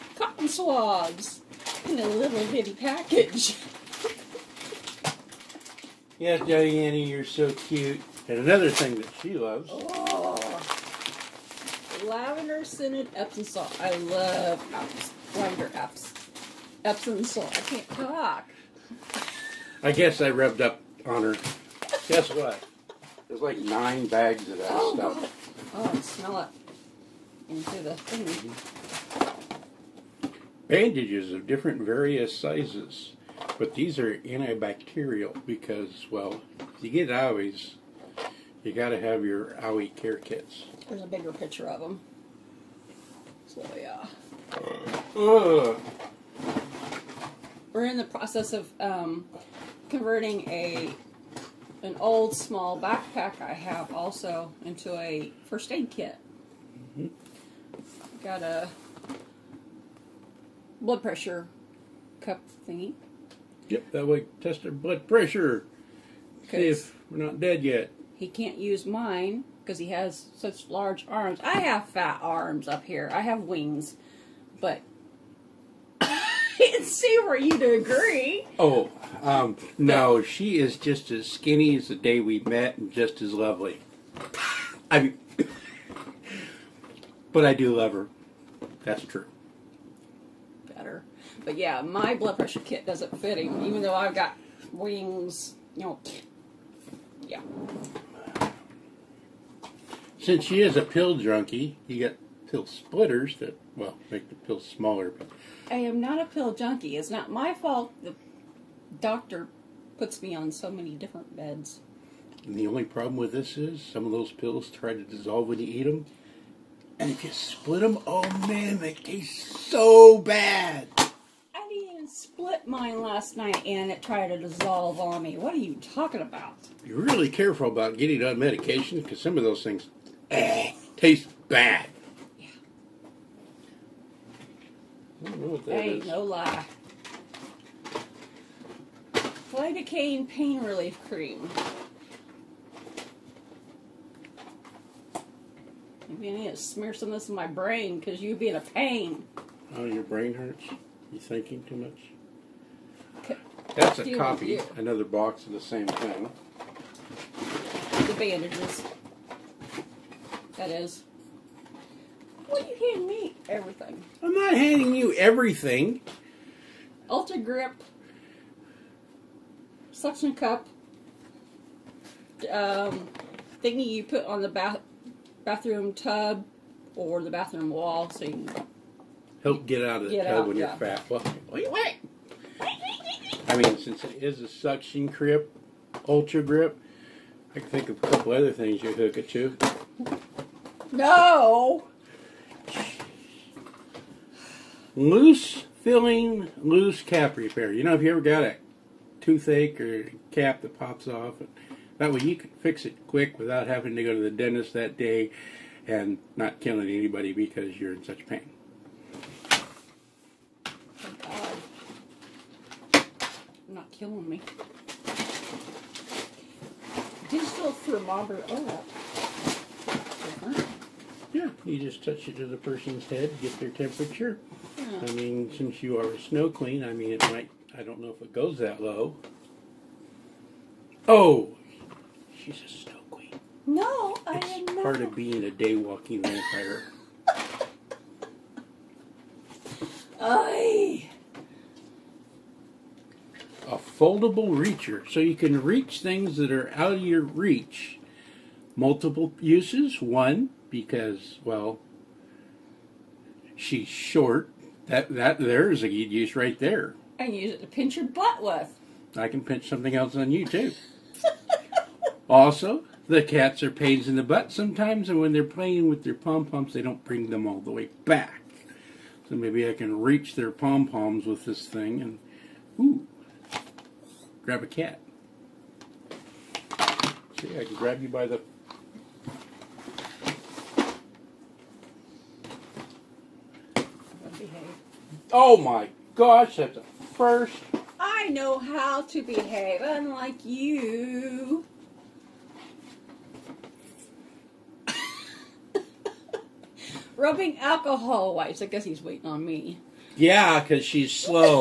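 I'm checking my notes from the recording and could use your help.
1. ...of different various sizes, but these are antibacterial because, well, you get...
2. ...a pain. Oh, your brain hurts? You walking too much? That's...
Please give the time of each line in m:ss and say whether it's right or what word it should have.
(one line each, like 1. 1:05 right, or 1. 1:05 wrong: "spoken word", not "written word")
1. 0:31 right
2. 2:28 wrong: "thinking", not "walking".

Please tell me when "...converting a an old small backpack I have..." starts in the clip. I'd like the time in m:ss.
0:49.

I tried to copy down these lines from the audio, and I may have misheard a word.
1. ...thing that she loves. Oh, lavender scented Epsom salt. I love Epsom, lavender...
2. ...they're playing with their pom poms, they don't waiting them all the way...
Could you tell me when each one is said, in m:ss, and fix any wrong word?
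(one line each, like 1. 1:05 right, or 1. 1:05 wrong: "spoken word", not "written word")
1. 0:08 right
2. 4:25 wrong: "bring", not "waiting".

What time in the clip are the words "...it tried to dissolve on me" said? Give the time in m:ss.
2:03.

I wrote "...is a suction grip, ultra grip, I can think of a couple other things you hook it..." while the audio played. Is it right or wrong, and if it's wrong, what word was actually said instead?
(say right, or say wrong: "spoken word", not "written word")
right.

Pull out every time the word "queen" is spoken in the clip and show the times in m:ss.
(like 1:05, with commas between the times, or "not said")
3:46, 3:53.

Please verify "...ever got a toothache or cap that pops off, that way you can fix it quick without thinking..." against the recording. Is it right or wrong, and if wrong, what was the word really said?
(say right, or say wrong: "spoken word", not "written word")
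wrong: "having", not "thinking".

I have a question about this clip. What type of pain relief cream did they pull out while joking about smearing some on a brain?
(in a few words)
Lidocaine.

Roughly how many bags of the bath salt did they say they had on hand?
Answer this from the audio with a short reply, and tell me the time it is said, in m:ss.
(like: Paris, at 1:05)
9, at 0:23.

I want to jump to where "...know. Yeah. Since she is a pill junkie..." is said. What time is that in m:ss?
1:35.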